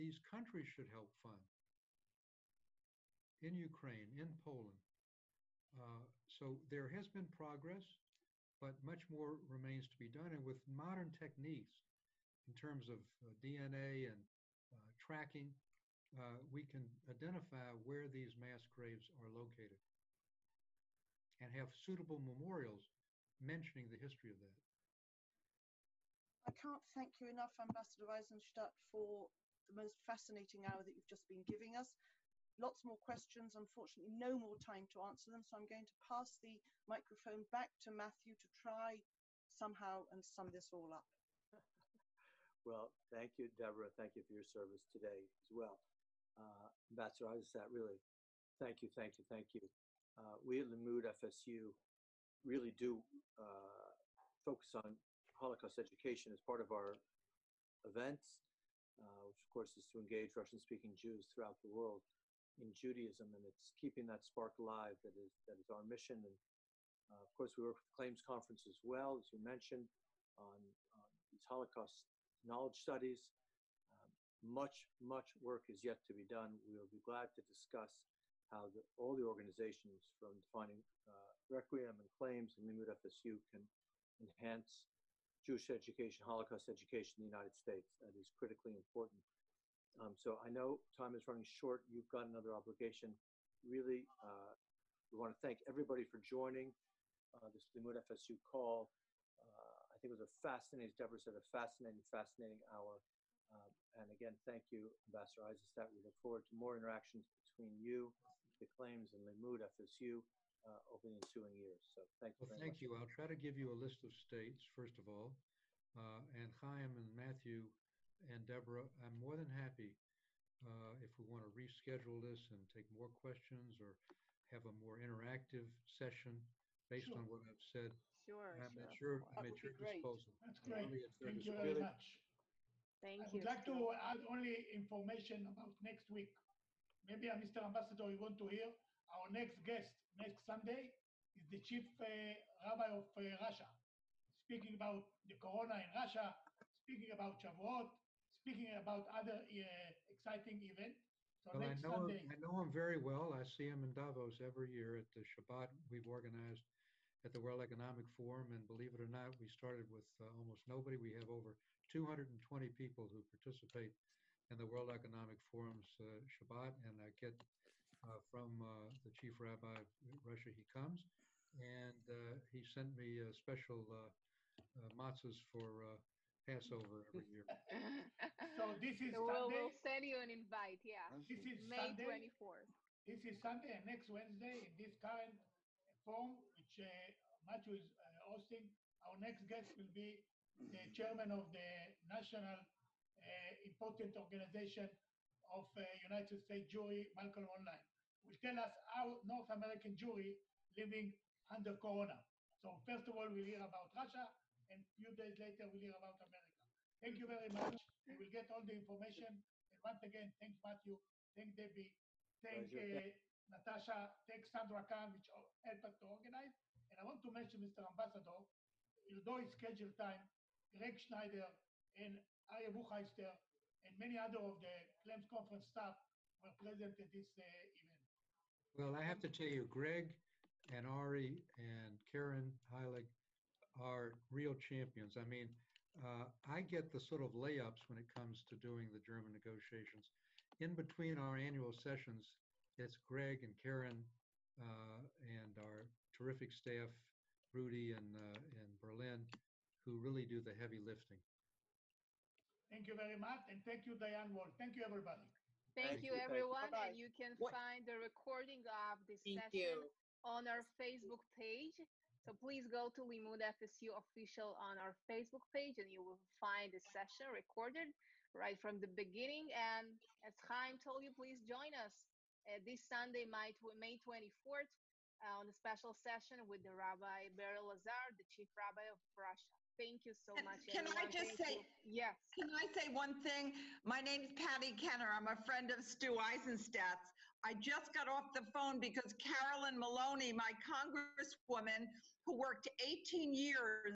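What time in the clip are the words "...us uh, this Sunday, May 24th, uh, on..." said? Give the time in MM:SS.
04:31.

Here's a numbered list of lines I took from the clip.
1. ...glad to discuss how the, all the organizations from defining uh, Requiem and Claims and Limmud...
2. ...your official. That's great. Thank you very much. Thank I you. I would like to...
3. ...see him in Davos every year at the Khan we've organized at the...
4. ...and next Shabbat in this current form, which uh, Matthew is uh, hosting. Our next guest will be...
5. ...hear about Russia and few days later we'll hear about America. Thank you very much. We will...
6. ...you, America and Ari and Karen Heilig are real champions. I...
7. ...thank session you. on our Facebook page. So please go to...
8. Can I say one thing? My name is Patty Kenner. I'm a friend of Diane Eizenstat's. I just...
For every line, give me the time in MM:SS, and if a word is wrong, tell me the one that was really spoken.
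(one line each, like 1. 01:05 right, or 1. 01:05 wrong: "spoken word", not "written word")
1. 01:17 right
2. 02:09 wrong: "disposal", not "official"
3. 02:33 wrong: "Shabbat", not "Khan"
4. 03:03 wrong: "Wednesday", not "Shabbat"
5. 03:23 right
6. 03:49 wrong: "Greg", not "America"
7. 04:19 right
8. 04:42 wrong: "Stu", not "Diane".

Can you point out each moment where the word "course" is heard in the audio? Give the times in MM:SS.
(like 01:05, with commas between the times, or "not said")
00:59, 01:07.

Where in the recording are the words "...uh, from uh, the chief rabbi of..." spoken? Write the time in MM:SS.
02:48.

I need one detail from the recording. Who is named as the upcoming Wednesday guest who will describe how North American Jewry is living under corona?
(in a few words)
Malcolm Hoenlein.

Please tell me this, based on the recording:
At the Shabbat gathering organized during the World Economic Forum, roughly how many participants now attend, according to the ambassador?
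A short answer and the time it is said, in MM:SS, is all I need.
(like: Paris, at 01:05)
over 220, at 02:41.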